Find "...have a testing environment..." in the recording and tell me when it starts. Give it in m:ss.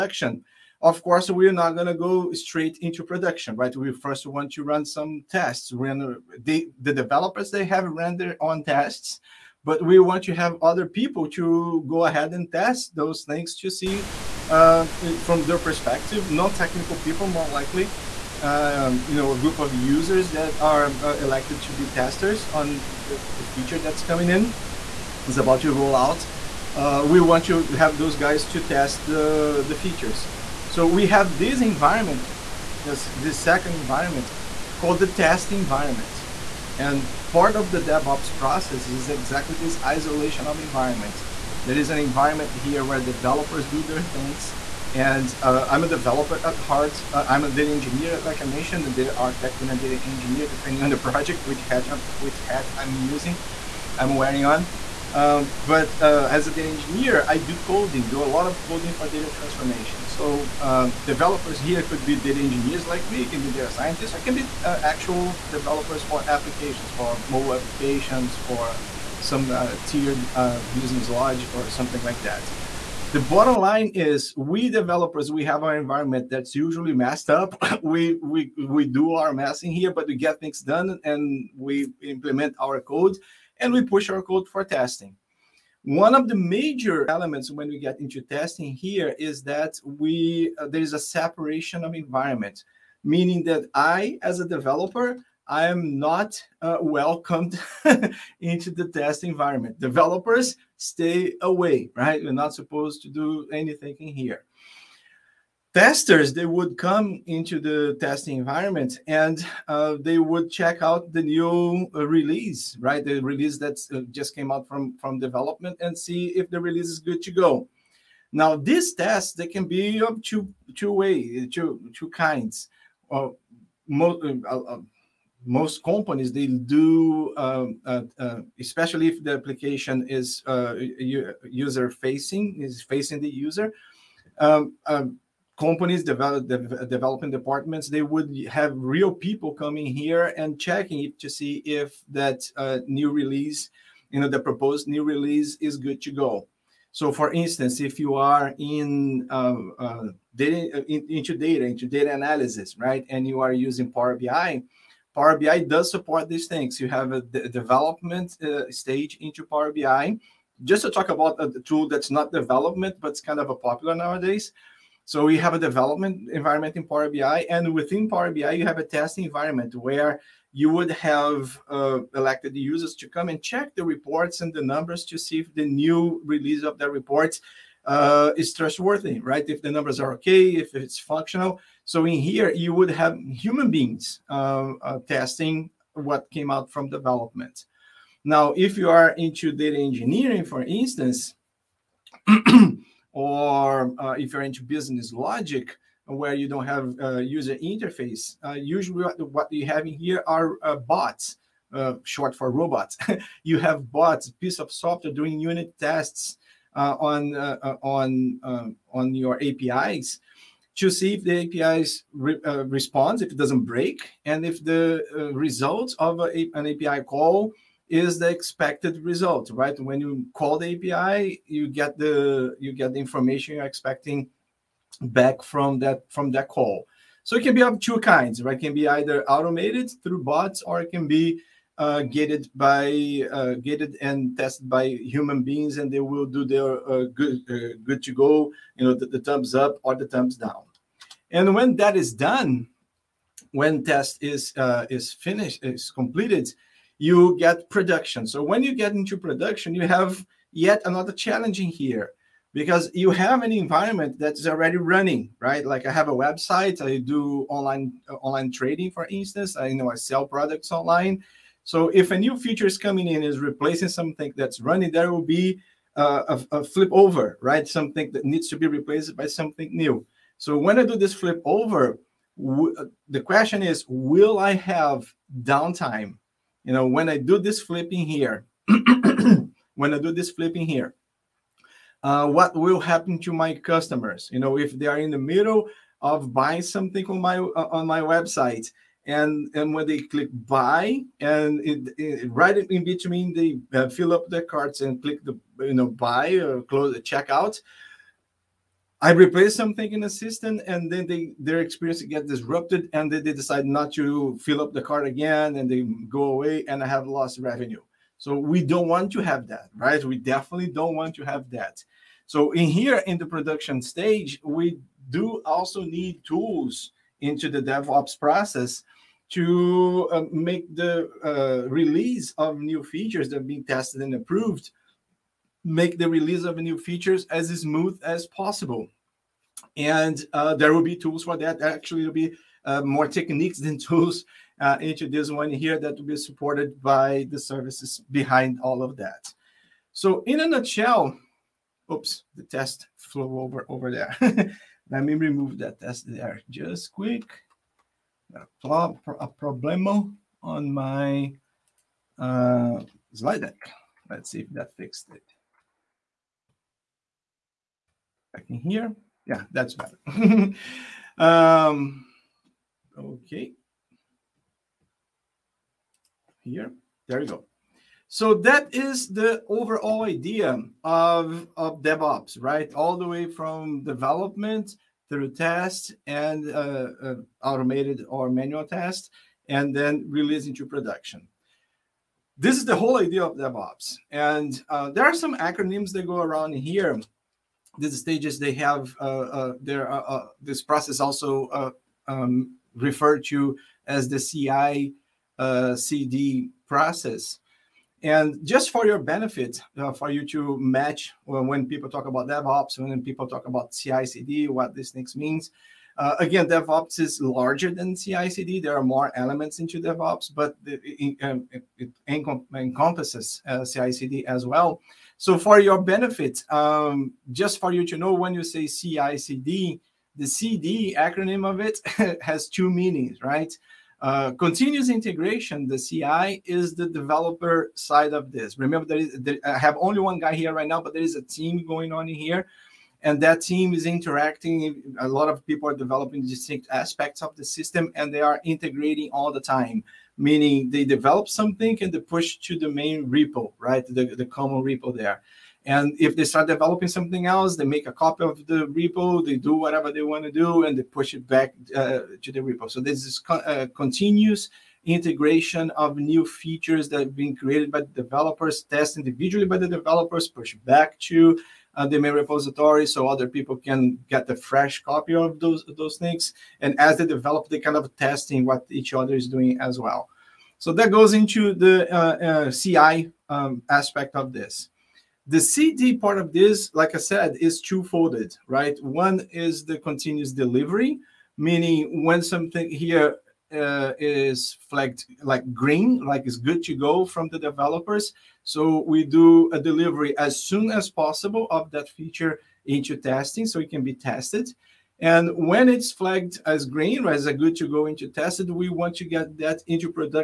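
2:48.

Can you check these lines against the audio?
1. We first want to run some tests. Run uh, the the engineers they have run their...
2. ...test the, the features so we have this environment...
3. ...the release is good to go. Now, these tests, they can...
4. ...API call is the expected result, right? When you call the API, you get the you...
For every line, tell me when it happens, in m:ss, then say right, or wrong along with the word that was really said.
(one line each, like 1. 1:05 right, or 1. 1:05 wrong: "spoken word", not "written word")
1. 0:03 wrong: "developers", not "engineers"
2. 0:28 right
3. 1:56 right
4. 3:36 right.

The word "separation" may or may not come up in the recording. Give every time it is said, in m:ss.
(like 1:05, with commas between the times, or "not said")
1:30.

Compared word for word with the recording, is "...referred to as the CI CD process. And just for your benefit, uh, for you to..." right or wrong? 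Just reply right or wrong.
right.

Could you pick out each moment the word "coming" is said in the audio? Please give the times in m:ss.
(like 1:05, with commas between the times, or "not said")
0:24, 2:19, 4:22.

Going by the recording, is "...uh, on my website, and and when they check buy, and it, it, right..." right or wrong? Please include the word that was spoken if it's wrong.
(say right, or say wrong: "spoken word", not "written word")
wrong: "click", not "check".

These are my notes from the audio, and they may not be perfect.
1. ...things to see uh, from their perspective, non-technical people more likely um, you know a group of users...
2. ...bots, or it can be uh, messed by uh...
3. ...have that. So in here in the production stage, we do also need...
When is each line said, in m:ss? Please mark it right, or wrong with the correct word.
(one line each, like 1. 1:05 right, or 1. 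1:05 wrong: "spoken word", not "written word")
1. 0:13 right
2. 3:50 wrong: "gated", not "messed"
3. 5:11 right.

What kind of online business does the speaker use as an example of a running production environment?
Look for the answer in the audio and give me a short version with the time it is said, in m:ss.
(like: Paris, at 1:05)
Online trading, at 4:18.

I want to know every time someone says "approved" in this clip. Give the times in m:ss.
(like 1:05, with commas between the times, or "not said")
5:24.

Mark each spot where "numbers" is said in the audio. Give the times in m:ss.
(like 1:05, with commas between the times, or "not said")
2:54, 2:59.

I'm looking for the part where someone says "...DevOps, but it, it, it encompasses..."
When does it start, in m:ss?
6:49.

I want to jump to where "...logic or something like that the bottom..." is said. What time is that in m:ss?
1:11.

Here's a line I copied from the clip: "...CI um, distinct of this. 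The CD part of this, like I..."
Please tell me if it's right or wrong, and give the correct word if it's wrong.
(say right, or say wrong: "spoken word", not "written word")
wrong: "aspect", not "distinct".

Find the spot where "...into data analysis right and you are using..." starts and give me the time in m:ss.
2:31.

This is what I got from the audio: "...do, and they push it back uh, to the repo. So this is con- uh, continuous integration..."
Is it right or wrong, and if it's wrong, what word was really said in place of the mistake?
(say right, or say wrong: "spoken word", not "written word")
right.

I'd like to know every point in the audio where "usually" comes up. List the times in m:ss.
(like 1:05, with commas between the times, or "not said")
1:16, 3:18.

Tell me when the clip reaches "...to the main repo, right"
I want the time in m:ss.
7:22.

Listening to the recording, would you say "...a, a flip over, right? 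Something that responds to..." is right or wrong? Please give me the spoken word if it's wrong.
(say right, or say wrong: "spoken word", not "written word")
wrong: "needs", not "responds".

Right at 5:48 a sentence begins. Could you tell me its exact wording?
A, pro a problemo on my uh, slide deck.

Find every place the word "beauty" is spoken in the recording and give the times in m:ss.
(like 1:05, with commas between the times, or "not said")
not said.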